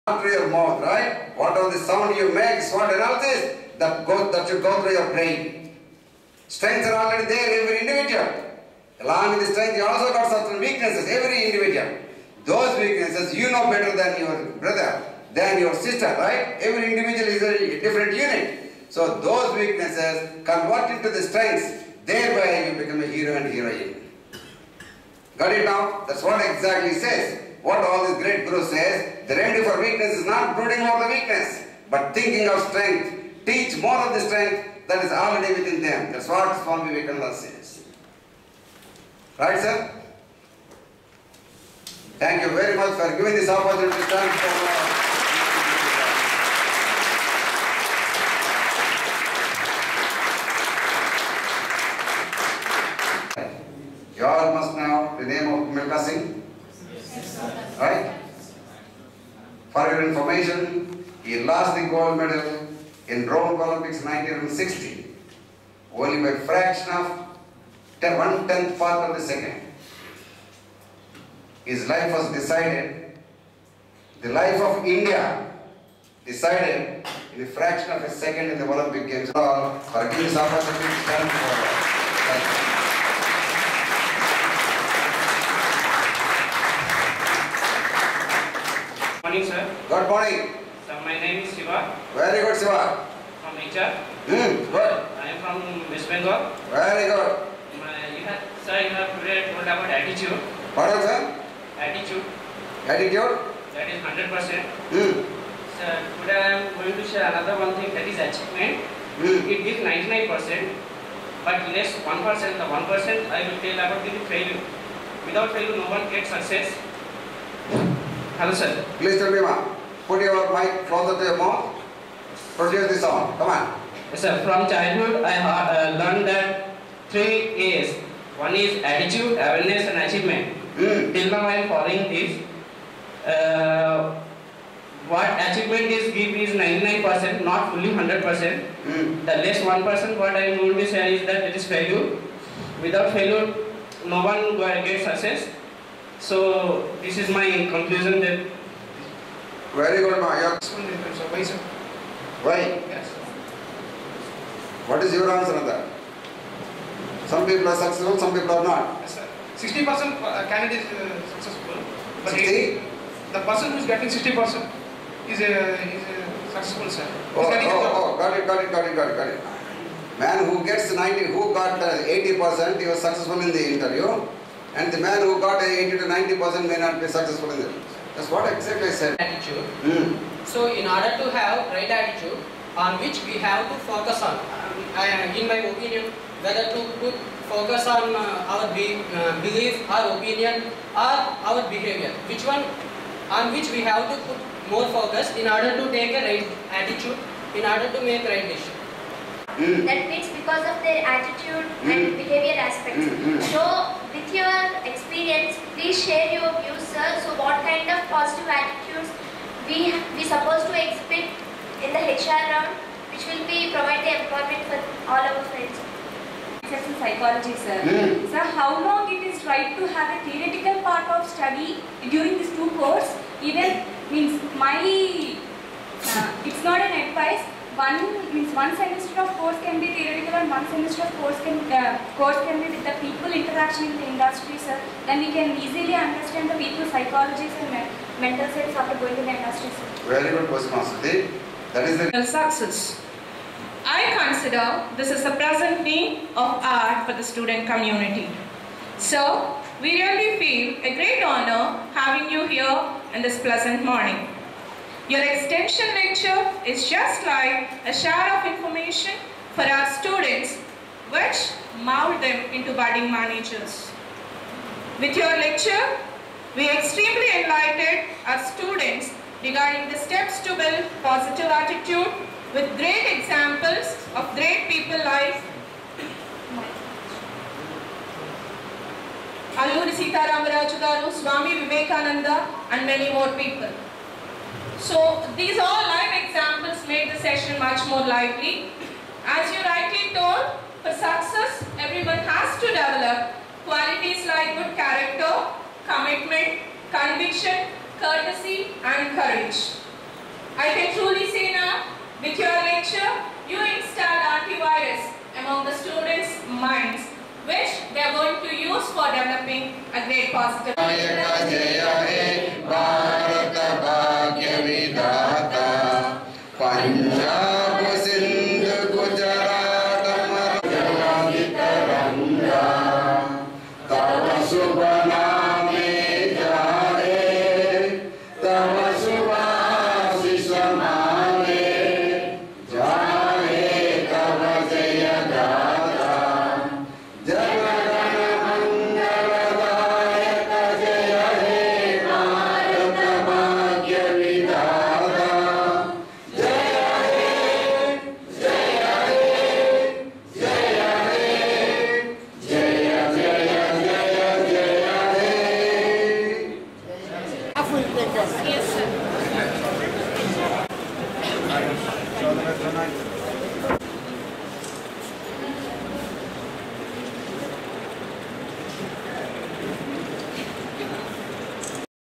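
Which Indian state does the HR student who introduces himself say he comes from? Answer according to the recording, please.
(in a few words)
West Bengal.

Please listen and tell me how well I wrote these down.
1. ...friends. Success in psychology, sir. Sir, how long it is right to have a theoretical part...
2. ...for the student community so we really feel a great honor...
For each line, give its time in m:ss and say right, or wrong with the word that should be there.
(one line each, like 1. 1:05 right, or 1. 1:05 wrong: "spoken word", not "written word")
1. 3:35 right
2. 4:07 right.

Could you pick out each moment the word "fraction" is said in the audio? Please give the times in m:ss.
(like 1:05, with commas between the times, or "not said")
1:06, 1:17.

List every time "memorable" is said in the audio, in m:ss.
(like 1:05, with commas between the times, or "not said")
not said.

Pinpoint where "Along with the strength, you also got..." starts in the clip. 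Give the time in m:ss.
0:08.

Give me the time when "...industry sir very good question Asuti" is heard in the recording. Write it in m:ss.
3:59.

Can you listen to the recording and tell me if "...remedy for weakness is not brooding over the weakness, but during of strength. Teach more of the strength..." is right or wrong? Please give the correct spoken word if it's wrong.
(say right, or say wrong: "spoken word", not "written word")
wrong: "thinking", not "during".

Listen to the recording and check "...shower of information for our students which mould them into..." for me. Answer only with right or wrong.
right.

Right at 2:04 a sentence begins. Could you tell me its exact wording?
From childhood, I uh, learned that three A's.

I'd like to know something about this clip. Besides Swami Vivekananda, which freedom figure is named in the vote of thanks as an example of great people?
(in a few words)
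Alluri Sita Ramaraju.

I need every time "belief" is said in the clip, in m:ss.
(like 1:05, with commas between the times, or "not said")
3:09.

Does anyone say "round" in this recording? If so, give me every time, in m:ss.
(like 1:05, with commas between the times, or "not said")
3:32.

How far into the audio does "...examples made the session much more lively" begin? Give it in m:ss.
4:46.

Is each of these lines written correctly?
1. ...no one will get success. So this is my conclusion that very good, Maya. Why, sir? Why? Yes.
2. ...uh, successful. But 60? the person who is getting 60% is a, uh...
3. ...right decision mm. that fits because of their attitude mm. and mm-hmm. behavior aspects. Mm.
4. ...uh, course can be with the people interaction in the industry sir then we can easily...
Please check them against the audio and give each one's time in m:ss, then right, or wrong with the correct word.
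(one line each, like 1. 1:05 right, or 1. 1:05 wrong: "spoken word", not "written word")
1. 2:24 right
2. 2:40 right
3. 3:18 right
4. 3:51 right.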